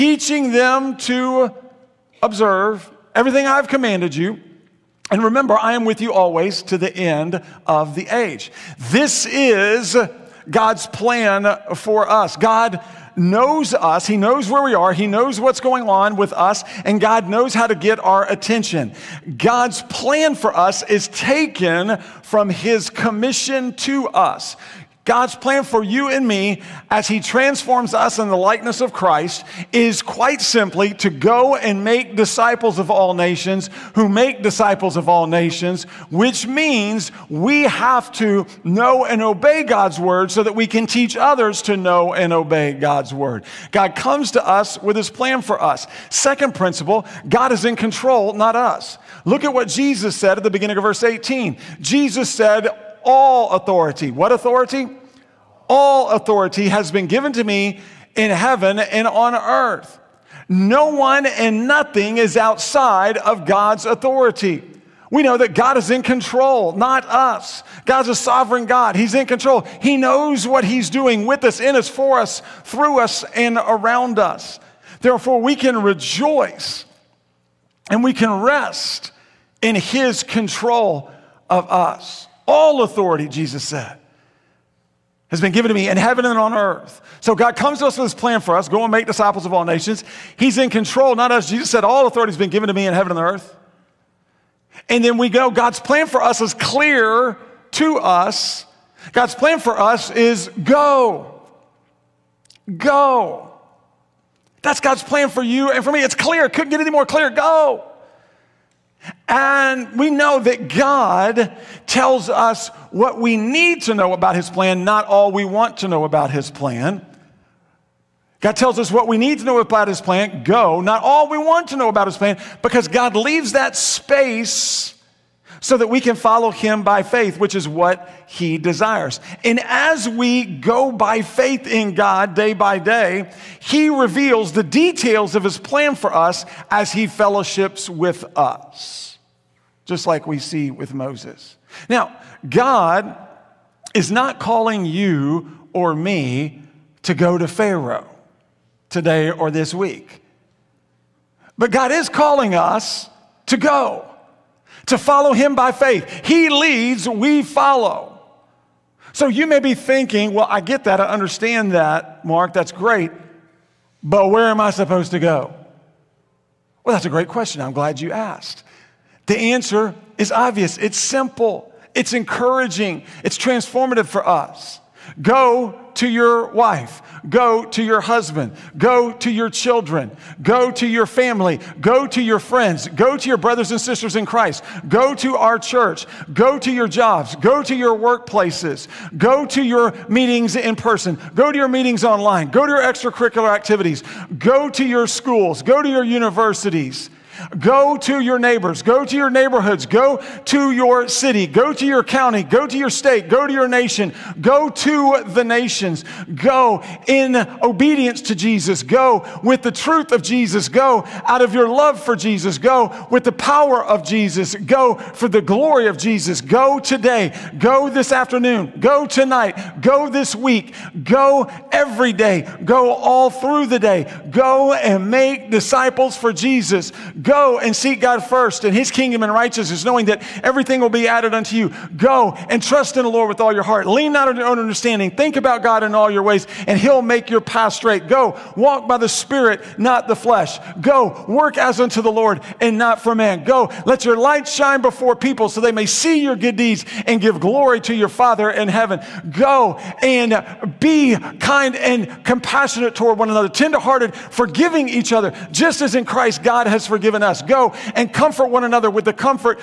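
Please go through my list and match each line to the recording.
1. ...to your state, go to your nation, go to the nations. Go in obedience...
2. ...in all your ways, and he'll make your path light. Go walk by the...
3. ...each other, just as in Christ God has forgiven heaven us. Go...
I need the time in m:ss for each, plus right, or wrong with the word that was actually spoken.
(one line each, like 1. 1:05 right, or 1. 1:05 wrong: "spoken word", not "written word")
1. 3:22 right
2. 3:55 wrong: "straight", not "light"
3. 4:14 wrong: "given", not "heaven".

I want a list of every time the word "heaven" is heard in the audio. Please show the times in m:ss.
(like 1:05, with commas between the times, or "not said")
0:58, 1:25, 1:32, 4:08.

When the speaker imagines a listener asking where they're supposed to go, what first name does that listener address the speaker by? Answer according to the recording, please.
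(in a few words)
Marc.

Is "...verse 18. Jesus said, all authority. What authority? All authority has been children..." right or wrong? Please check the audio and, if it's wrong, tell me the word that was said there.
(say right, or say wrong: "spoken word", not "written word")
wrong: "given", not "children".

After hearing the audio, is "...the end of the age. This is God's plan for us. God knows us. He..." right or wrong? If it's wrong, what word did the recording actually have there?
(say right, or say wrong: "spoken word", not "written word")
right.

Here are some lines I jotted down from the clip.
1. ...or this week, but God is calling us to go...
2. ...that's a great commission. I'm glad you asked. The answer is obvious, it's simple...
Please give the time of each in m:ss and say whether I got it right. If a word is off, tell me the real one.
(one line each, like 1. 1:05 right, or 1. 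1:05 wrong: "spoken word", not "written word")
1. 2:29 right
2. 2:46 wrong: "question", not "commission".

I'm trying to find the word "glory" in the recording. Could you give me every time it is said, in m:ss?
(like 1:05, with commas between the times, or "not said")
3:35, 4:07.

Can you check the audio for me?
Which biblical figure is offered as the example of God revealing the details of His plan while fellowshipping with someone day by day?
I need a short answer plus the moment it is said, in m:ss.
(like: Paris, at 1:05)
Moses, at 2:20.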